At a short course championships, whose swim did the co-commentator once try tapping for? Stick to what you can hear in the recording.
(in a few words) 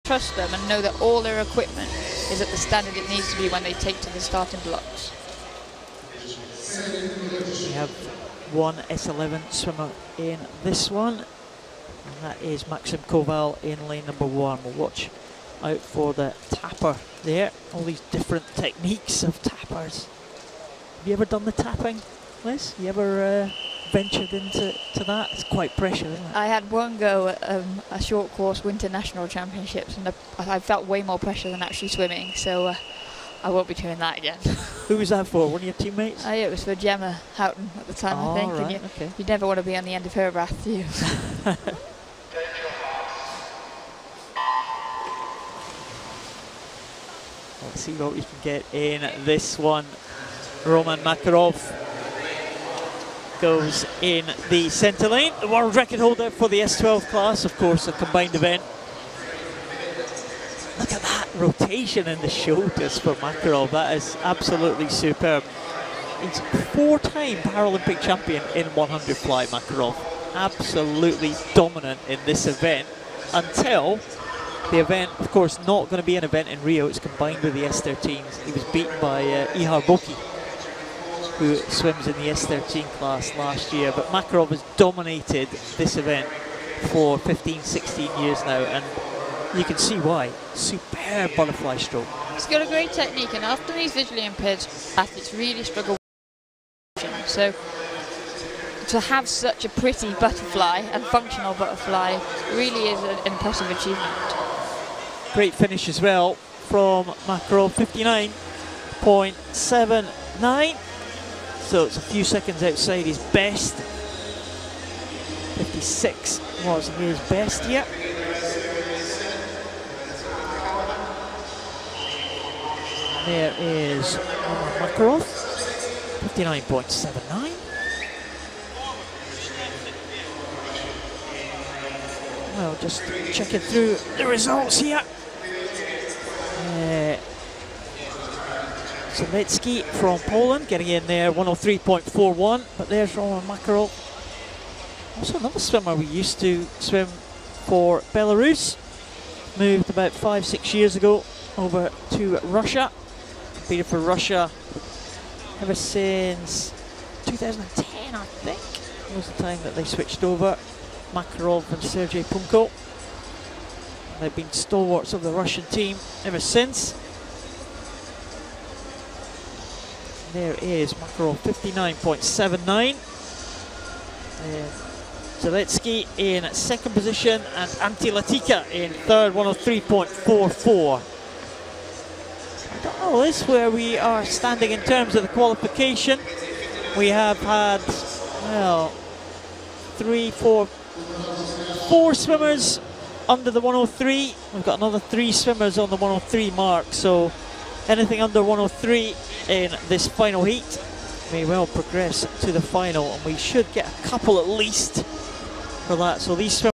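Gemma Houghton.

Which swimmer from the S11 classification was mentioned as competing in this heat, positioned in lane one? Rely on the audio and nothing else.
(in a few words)
Maxim Koval.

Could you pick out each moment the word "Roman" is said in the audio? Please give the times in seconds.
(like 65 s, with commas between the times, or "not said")
50 s, 143 s.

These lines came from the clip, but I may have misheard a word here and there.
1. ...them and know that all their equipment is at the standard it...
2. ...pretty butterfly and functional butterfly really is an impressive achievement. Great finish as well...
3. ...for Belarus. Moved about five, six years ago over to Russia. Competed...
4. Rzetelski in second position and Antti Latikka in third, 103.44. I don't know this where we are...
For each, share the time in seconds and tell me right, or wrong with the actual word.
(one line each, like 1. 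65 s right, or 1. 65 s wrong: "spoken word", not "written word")
1. 0 s right
2. 99 s right
3. 147 s right
4. 175 s right.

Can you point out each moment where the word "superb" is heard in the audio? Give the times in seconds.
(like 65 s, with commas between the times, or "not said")
64 s, 90 s.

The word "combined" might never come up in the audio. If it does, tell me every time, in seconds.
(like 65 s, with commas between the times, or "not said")
57 s, 76 s.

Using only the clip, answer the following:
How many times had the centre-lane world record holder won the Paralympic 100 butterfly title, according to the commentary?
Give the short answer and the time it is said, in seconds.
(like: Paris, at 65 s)
4, at 66 s.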